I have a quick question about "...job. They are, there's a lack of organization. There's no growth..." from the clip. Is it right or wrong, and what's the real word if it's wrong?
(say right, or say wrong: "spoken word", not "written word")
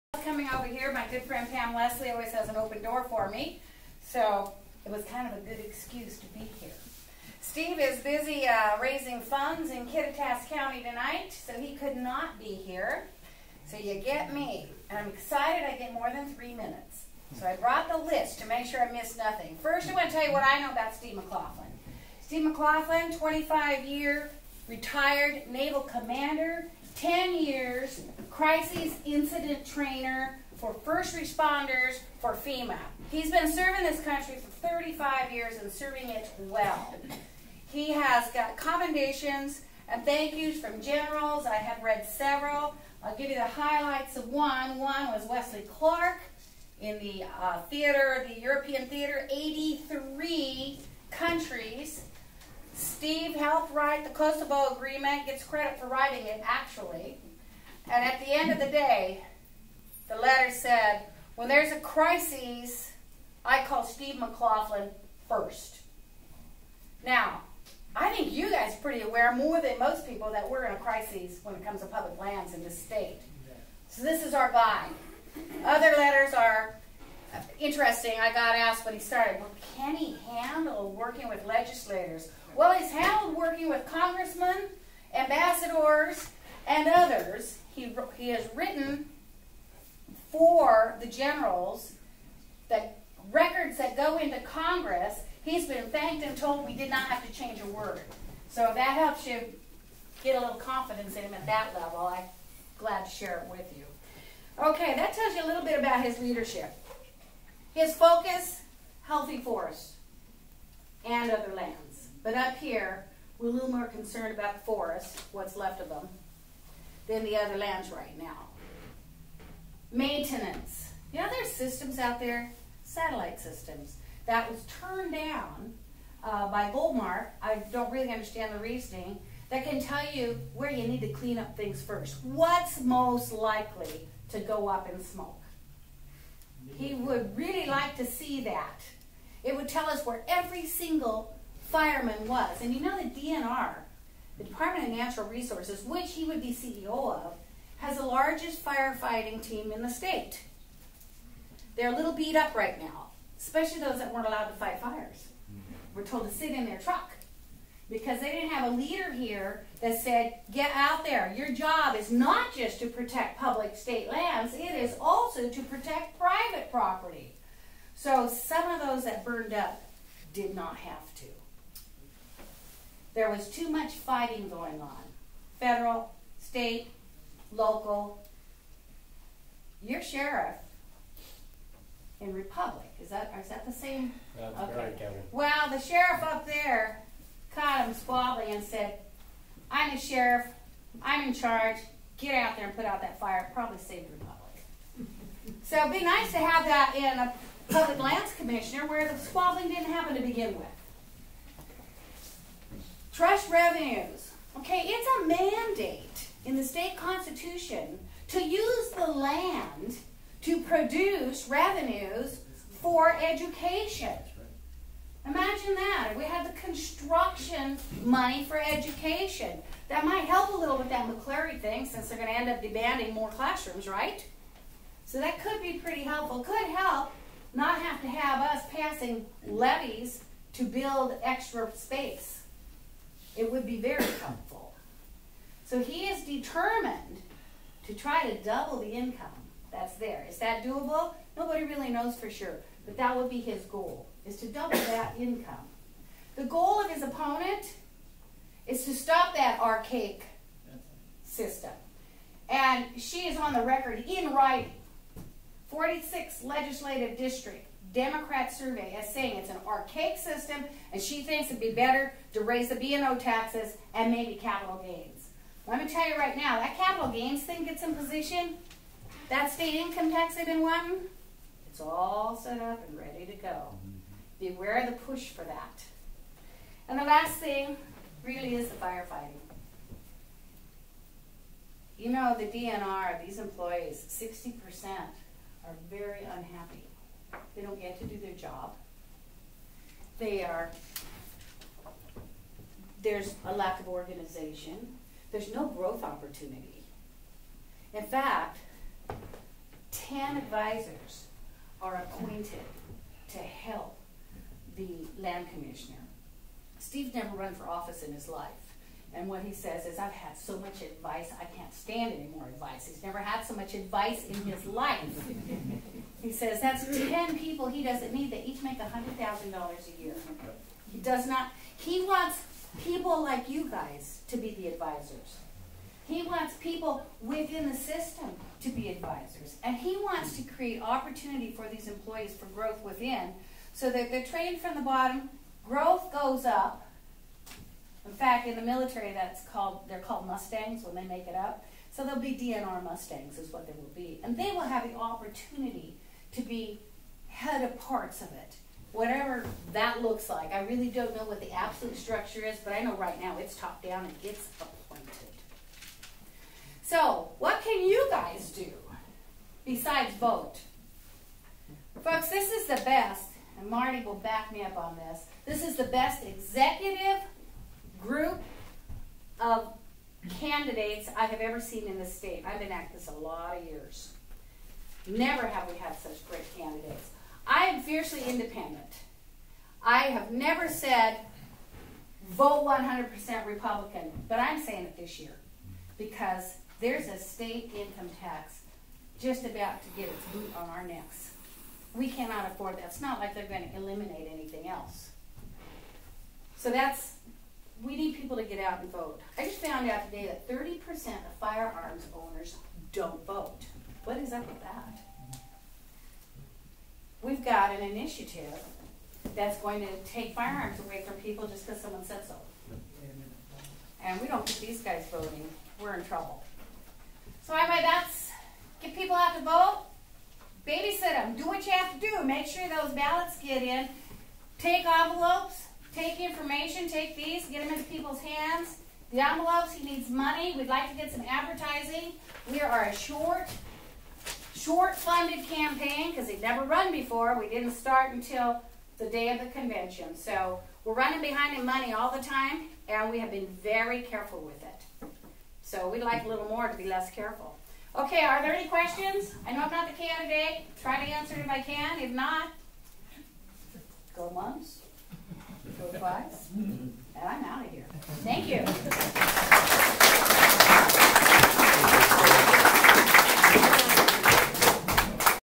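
right.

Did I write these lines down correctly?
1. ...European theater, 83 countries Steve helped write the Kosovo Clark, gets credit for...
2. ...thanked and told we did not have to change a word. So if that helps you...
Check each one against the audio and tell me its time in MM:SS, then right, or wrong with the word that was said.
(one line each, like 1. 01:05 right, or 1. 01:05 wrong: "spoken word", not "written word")
1. 00:48 wrong: "Agreement", not "Clark"
2. 01:35 right.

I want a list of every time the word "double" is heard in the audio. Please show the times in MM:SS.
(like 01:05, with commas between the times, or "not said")
03:58, 04:04.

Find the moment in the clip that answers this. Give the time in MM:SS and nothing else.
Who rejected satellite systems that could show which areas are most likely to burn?
02:06.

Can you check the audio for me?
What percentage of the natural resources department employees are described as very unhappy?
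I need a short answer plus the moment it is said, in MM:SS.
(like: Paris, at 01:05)
60%, at 04:44.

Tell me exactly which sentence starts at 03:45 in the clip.
So that could be pretty helpful.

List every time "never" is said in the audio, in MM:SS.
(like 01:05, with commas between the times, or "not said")
05:07, 05:13, 06:15, 06:20, 07:16.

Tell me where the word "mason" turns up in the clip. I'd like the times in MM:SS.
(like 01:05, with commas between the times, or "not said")
not said.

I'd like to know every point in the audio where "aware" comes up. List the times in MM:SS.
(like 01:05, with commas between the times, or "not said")
01:09, 04:34.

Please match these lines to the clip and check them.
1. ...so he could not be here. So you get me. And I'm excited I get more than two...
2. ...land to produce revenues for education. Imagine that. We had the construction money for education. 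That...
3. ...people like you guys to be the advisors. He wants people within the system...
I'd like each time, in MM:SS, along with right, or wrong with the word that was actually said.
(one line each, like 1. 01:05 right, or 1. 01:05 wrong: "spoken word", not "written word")
1. 00:11 wrong: "three", not "two"
2. 03:29 right
3. 05:22 right.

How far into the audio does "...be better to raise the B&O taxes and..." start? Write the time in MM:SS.
04:21.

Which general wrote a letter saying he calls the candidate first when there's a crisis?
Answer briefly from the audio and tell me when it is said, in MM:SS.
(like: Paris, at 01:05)
Wesley Clark, at 00:45.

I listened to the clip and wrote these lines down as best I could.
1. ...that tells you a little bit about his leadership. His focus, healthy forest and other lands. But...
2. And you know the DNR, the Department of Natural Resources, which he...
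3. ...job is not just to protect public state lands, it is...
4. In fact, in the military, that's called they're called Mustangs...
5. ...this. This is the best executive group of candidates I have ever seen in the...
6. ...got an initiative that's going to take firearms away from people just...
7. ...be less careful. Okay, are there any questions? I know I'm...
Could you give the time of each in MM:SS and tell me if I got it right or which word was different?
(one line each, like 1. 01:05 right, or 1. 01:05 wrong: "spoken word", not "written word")
1. 01:44 right
2. 02:22 right
3. 02:41 right
4. 05:38 right
5. 06:04 right
6. 06:47 right
7. 07:26 right.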